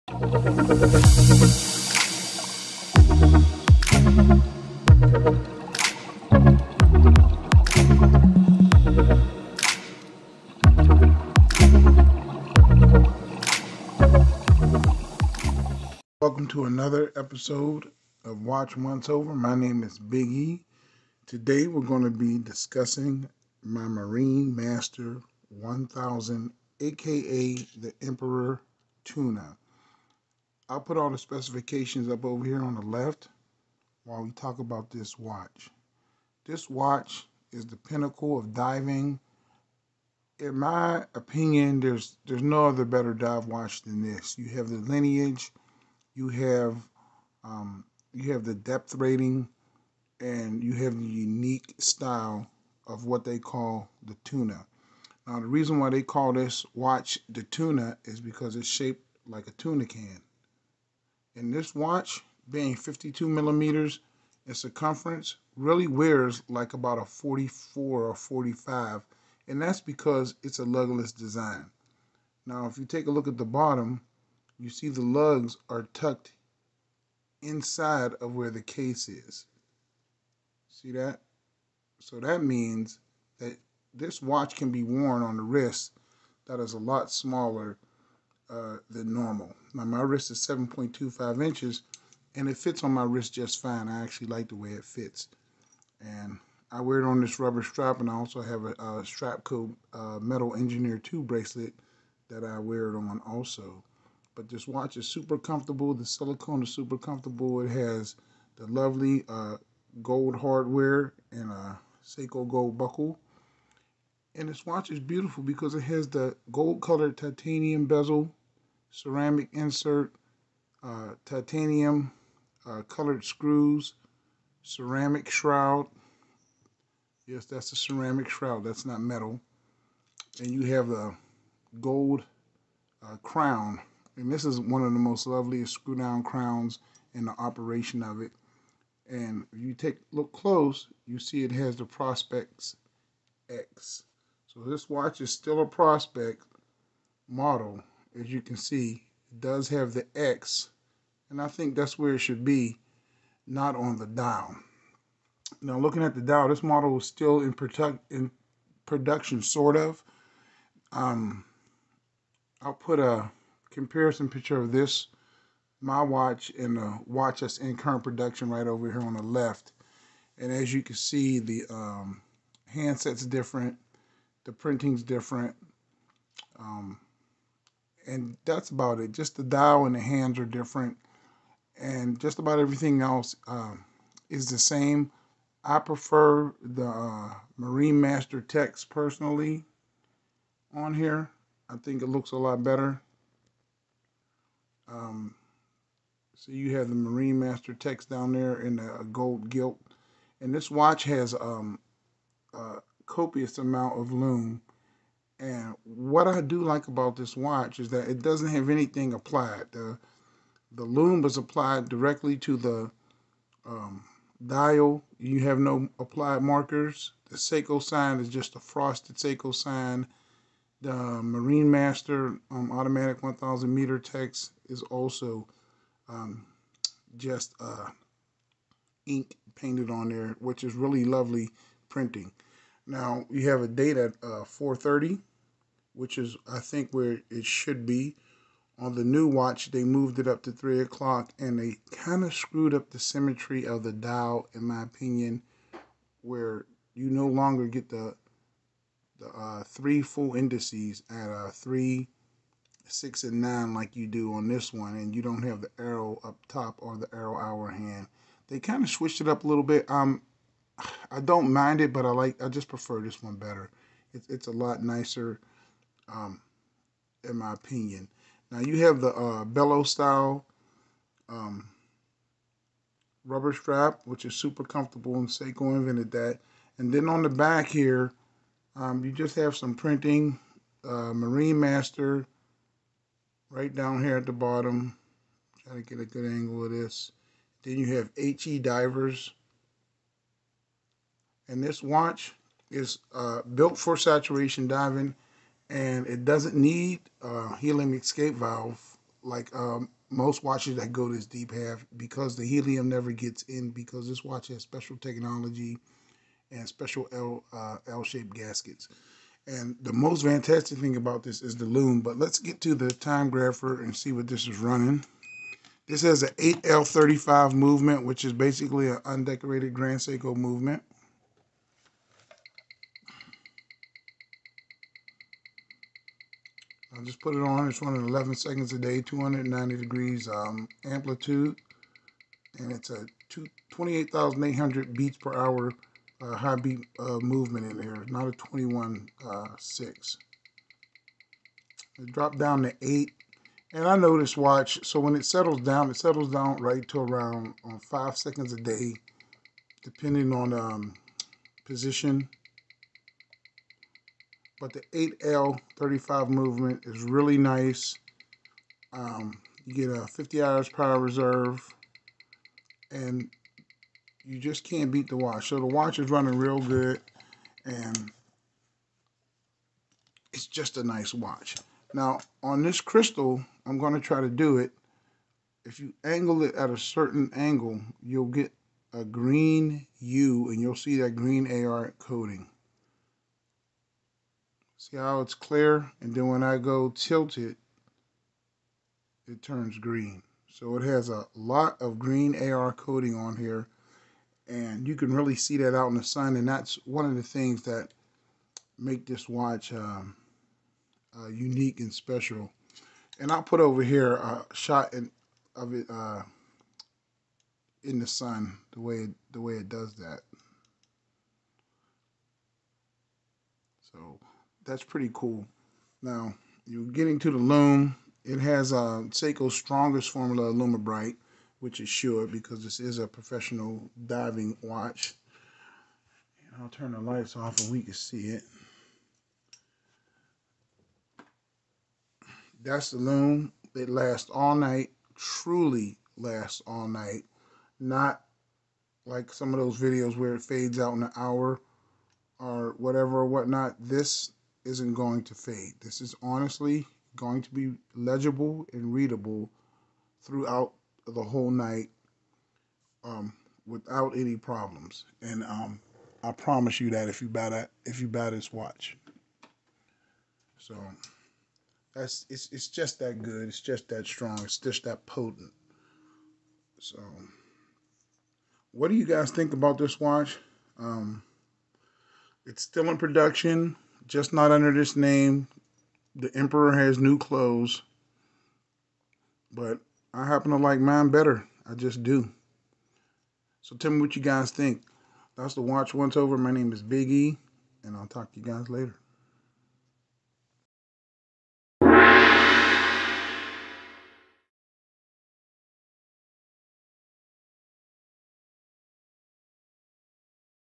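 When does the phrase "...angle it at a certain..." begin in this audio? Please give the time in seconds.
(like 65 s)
376 s.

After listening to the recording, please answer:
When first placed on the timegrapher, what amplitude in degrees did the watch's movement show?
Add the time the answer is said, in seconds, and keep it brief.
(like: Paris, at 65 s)
290 degrees, at 329 s.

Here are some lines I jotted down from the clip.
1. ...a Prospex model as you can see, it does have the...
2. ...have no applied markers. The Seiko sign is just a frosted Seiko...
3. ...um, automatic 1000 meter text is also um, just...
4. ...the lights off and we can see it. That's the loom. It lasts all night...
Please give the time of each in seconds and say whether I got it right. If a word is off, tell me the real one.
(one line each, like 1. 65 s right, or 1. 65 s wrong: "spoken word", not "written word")
1. 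145 s right
2. 215 s right
3. 222 s right
4. 426 s right.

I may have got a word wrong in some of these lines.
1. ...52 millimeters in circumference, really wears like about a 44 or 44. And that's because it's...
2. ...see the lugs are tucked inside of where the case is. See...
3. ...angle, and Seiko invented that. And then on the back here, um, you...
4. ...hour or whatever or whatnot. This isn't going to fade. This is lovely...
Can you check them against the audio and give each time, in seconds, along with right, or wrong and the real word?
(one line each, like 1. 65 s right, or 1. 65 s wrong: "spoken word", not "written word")
1. 62 s wrong: "45", not "44"
2. 74 s right
3. 274 s wrong: "comfortable", not "angle"
4. 441 s wrong: "honestly", not "lovely".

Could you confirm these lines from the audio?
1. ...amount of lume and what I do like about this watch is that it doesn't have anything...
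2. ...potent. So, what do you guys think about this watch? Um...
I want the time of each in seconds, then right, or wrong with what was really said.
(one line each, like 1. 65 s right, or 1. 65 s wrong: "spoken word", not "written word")
1. 203 s right
2. 465 s right.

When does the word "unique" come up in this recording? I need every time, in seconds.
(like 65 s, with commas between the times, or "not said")
51 s, 401 s.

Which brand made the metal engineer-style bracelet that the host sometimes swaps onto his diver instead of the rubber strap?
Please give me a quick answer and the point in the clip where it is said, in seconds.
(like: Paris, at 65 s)
Strapcode, at 99 s.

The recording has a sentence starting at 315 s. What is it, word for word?
This has an 8L35 movement, which is basically an undecorated Grand Seiko movement.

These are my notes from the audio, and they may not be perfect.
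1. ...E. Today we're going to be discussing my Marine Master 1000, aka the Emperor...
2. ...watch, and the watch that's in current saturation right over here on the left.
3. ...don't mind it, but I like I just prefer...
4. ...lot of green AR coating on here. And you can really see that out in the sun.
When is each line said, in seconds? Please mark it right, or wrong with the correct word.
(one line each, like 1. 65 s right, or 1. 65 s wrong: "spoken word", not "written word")
1. 20 s right
2. 166 s wrong: "production", not "saturation"
3. 261 s right
4. 391 s right.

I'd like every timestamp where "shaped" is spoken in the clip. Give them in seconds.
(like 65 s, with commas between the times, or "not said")
58 s, 307 s.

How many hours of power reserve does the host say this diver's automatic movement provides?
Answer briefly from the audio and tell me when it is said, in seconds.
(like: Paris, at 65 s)
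50 hours, at 360 s.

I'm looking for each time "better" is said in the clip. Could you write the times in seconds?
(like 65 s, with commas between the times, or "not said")
42 s, 192 s, 263 s, 481 s.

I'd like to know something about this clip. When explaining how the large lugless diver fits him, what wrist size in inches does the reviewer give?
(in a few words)
7.25 inches.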